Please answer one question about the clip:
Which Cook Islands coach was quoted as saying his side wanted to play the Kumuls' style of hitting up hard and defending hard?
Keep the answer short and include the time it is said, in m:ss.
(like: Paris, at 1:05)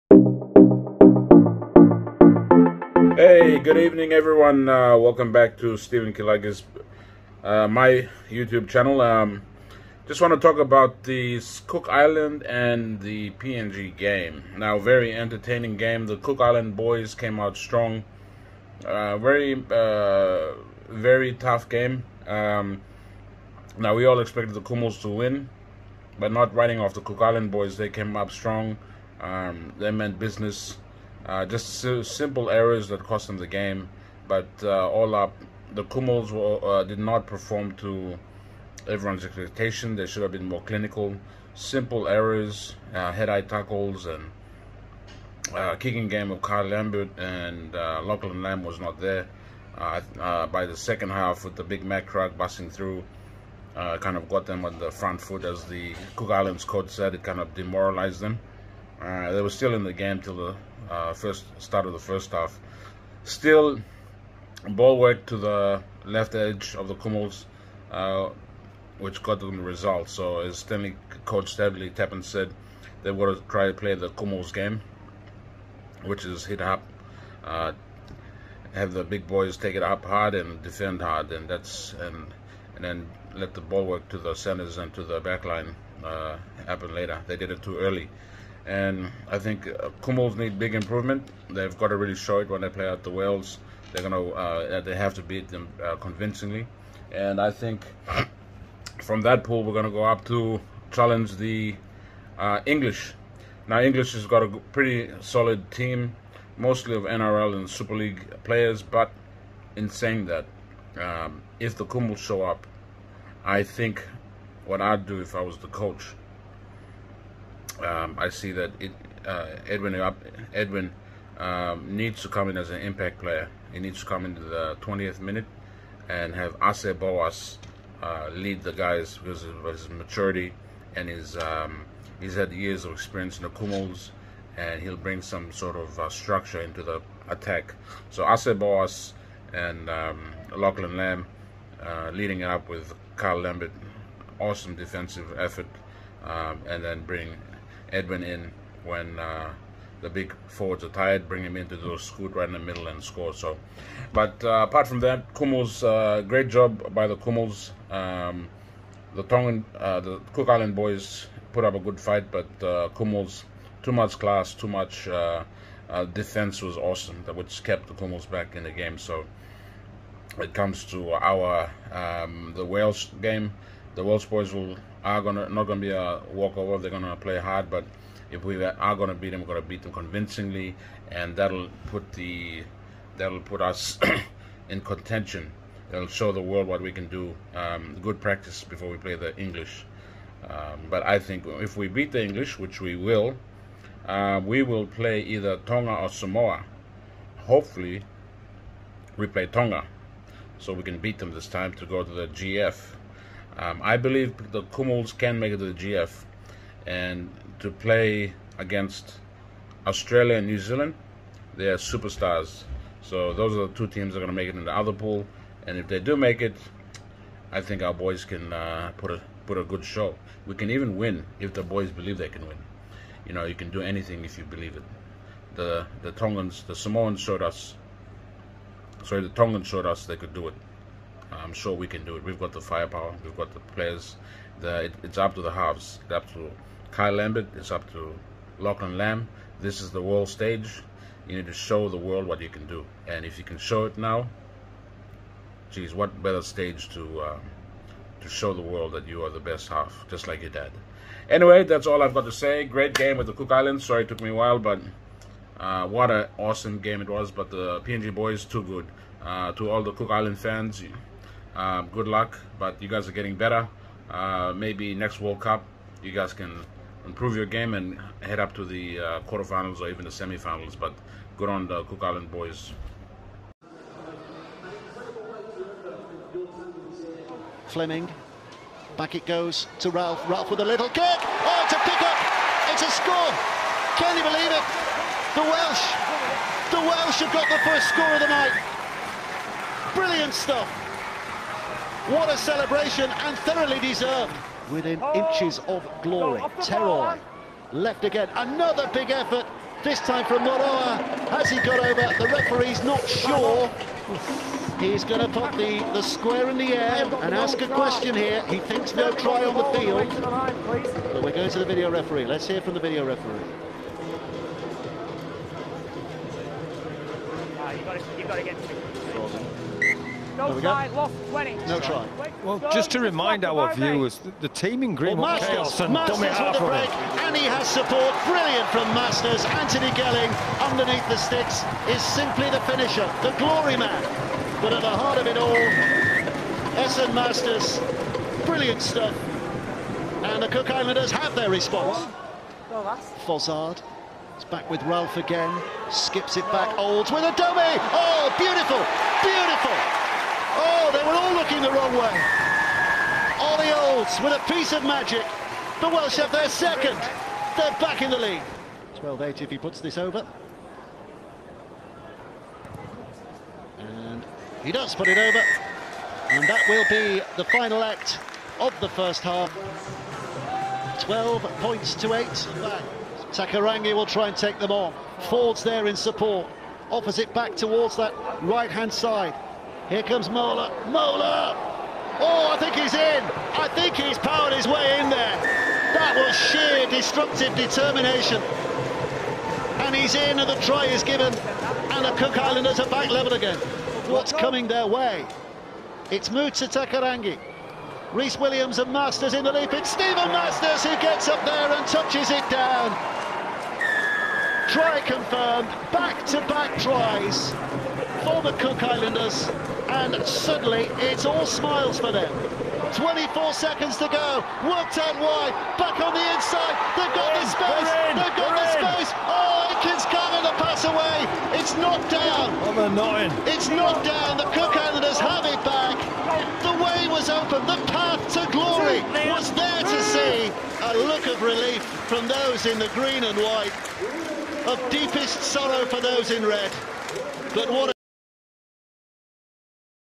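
Stanley Tappan, at 1:11.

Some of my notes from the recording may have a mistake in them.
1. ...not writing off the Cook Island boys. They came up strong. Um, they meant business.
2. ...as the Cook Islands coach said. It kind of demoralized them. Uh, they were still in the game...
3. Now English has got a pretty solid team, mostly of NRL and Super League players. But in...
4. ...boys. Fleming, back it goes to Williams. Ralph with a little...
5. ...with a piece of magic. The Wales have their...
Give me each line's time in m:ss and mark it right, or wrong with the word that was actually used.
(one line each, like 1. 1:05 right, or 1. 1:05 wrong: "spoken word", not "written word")
1. 0:26 right
2. 0:55 right
3. 1:43 right
4. 4:32 wrong: "Ralph", not "Williams"
5. 5:54 wrong: "Welsh", not "Wales".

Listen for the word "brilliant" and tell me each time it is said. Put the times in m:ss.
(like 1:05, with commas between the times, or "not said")
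4:49, 5:28, 5:38.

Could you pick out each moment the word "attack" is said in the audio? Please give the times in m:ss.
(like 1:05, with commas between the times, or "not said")
2:17.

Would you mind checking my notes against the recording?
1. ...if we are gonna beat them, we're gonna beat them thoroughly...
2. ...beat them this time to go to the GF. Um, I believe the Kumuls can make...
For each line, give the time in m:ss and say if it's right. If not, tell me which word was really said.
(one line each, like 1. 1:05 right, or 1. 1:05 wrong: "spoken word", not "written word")
1. 2:58 wrong: "convincingly", not "thoroughly"
2. 3:20 right.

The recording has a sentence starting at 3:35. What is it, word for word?
And if they do make it, I think our boys can uh, put a put a good show.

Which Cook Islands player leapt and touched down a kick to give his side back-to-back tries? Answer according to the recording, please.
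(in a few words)
Steven Marsters.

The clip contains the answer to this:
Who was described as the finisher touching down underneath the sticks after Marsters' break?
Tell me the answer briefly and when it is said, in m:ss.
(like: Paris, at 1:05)
Anthony Gelling, at 5:29.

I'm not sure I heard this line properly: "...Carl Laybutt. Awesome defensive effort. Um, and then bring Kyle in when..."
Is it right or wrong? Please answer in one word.
wrong.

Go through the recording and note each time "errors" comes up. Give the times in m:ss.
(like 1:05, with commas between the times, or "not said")
0:32, 0:42.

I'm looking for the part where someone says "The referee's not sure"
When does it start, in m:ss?
5:02.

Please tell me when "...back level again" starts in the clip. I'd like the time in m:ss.
6:32.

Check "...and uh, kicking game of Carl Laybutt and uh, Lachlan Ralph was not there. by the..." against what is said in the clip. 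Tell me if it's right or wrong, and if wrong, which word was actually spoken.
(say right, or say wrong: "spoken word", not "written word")
wrong: "Lam", not "Ralph".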